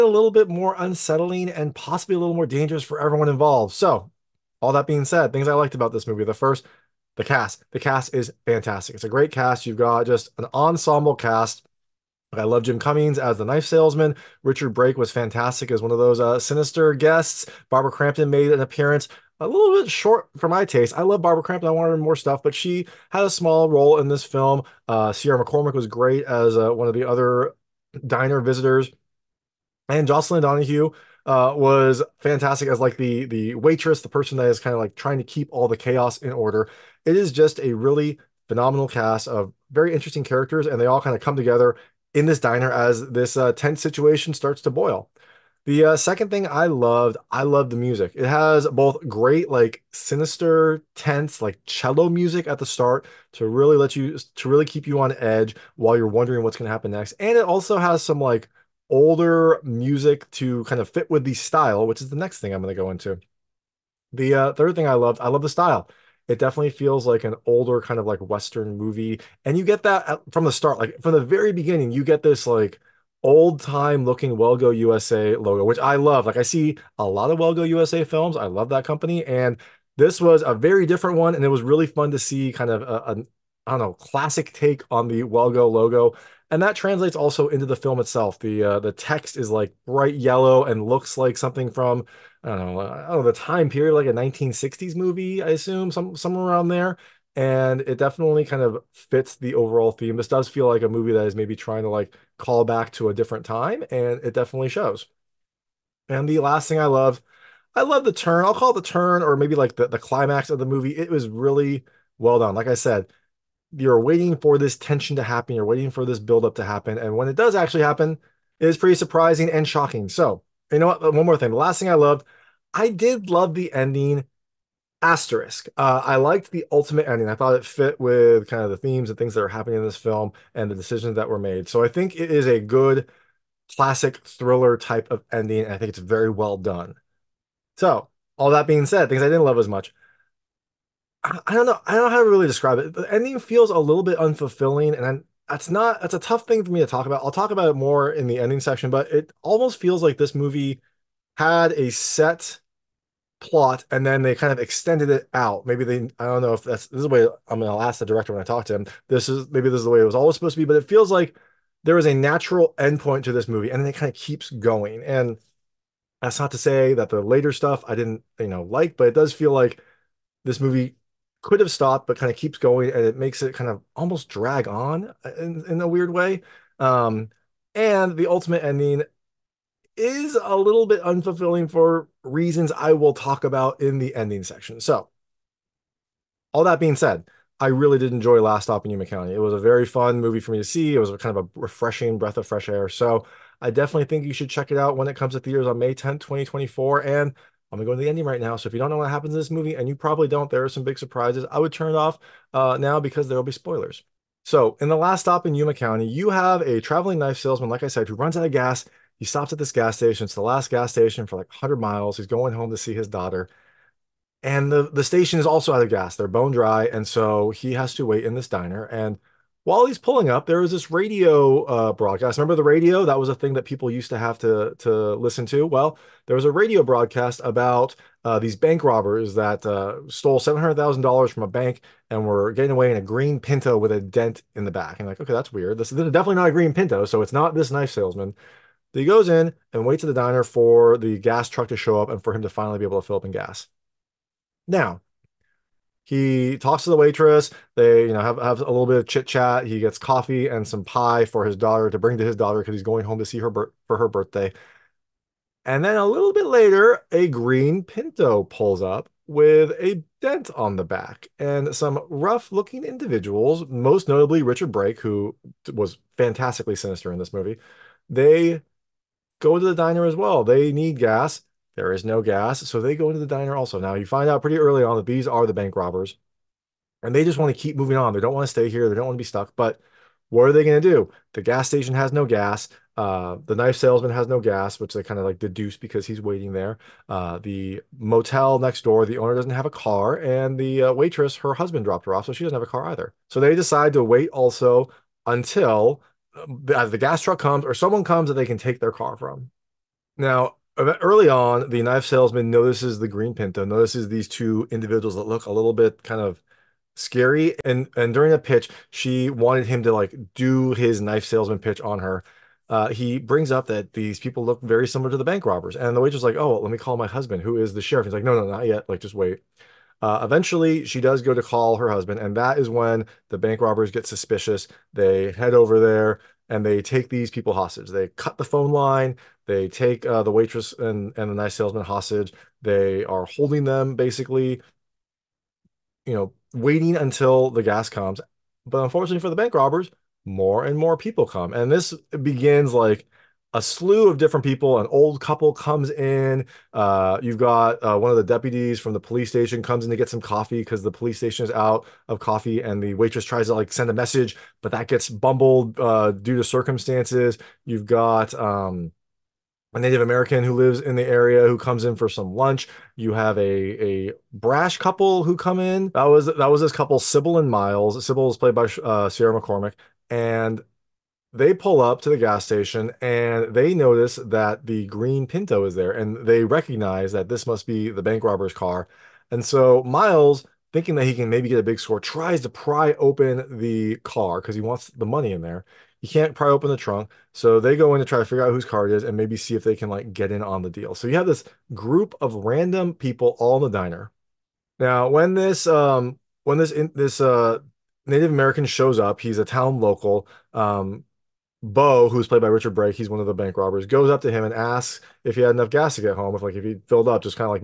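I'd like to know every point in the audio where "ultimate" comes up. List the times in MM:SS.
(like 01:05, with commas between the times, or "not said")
02:06, 02:58.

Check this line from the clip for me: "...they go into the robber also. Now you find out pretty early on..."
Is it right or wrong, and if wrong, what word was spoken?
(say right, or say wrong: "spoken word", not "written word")
wrong: "diner", not "robber".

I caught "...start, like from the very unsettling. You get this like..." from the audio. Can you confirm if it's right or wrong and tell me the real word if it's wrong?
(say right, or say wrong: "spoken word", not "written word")
wrong: "beginning", not "unsettling".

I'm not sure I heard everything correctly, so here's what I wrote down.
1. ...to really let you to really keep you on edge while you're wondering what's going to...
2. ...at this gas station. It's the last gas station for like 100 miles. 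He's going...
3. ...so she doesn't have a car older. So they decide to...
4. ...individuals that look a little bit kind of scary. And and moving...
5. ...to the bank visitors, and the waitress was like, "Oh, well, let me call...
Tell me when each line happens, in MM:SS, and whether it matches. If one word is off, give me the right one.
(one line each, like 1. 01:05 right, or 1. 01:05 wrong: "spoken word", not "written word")
1. 00:53 right
2. 03:29 right
3. 04:52 wrong: "either", not "older"
4. 05:04 wrong: "during", not "moving"
5. 05:15 wrong: "robbers", not "visitors".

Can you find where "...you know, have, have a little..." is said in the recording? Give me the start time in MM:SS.
04:08.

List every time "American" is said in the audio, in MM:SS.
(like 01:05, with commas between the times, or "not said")
06:00, 06:38.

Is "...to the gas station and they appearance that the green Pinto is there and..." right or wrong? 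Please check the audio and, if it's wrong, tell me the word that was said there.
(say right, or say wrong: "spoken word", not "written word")
wrong: "notice", not "appearance".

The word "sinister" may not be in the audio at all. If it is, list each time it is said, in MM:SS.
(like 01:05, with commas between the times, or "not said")
00:16, 00:49, 04:26.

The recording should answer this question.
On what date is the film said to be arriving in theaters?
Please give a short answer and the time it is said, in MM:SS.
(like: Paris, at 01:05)
May 10th, 2024, at 03:15.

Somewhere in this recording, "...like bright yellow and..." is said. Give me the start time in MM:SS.
01:29.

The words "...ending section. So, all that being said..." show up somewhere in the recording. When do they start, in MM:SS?
03:04.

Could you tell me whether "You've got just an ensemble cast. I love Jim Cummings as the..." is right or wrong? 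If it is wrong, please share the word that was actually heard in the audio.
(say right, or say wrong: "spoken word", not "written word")
right.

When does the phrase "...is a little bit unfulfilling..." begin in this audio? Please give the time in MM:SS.
02:59.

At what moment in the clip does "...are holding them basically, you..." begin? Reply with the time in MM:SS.
05:33.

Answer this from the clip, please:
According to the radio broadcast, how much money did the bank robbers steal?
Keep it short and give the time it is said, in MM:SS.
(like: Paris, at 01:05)
$700,000, at 03:50.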